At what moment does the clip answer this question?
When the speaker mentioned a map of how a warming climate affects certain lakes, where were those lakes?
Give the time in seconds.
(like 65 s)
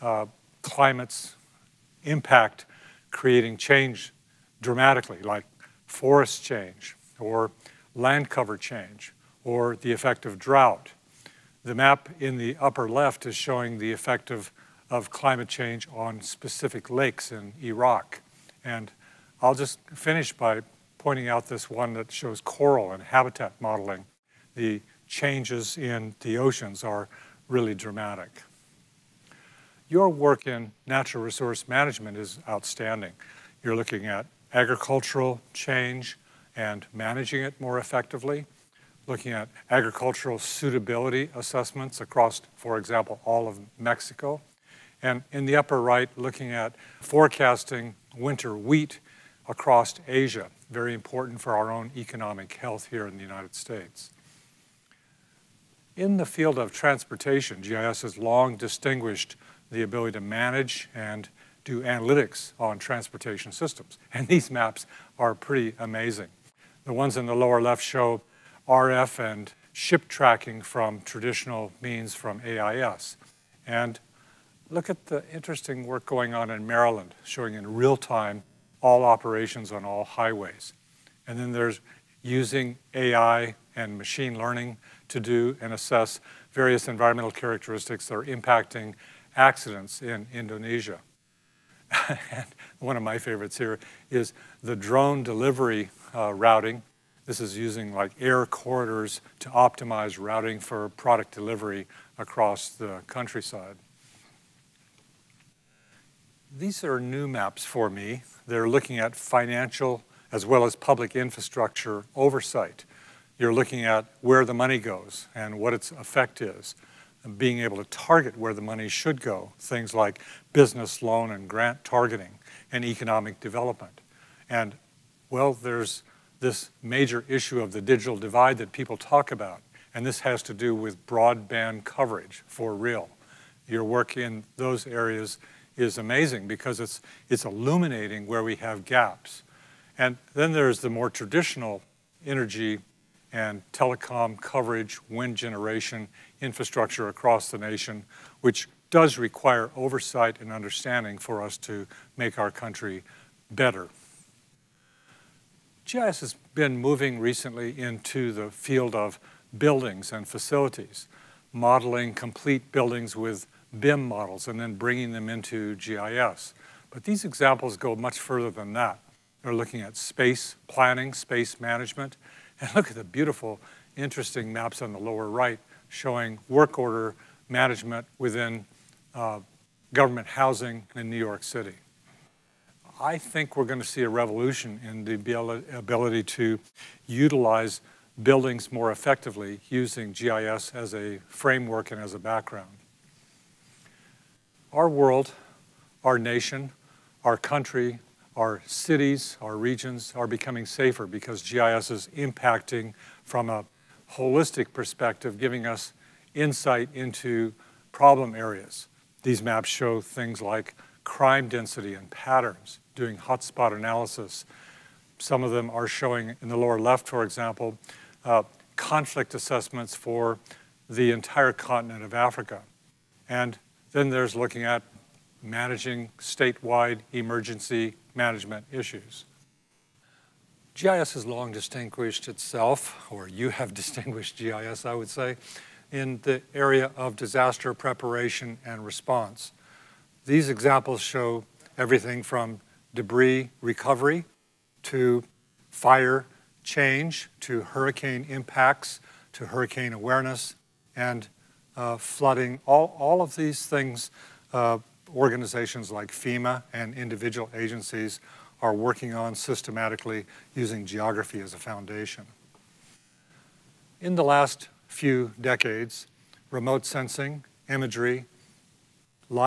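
17 s.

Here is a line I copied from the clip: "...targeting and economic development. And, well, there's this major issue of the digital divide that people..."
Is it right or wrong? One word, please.
right.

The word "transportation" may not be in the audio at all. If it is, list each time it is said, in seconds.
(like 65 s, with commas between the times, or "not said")
56 s, 62 s.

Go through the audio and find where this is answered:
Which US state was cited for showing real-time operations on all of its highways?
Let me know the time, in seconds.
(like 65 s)
76 s.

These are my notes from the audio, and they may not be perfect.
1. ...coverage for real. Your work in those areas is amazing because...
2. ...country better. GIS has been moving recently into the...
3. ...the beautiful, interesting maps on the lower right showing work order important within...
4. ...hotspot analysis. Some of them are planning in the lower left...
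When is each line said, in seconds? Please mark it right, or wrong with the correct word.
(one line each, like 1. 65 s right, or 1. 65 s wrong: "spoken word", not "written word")
1. 131 s right
2. 152 s right
3. 172 s wrong: "management", not "important"
4. 213 s wrong: "showing", not "planning".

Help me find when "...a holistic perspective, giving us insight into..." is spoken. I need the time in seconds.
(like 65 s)
203 s.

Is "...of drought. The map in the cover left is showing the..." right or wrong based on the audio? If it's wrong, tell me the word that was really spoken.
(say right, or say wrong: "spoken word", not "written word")
wrong: "upper", not "cover".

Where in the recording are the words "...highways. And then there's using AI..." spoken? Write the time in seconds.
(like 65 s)
80 s.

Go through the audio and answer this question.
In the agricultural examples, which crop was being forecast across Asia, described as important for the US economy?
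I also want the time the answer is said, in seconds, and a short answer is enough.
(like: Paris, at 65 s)
Winter wheat, at 48 s.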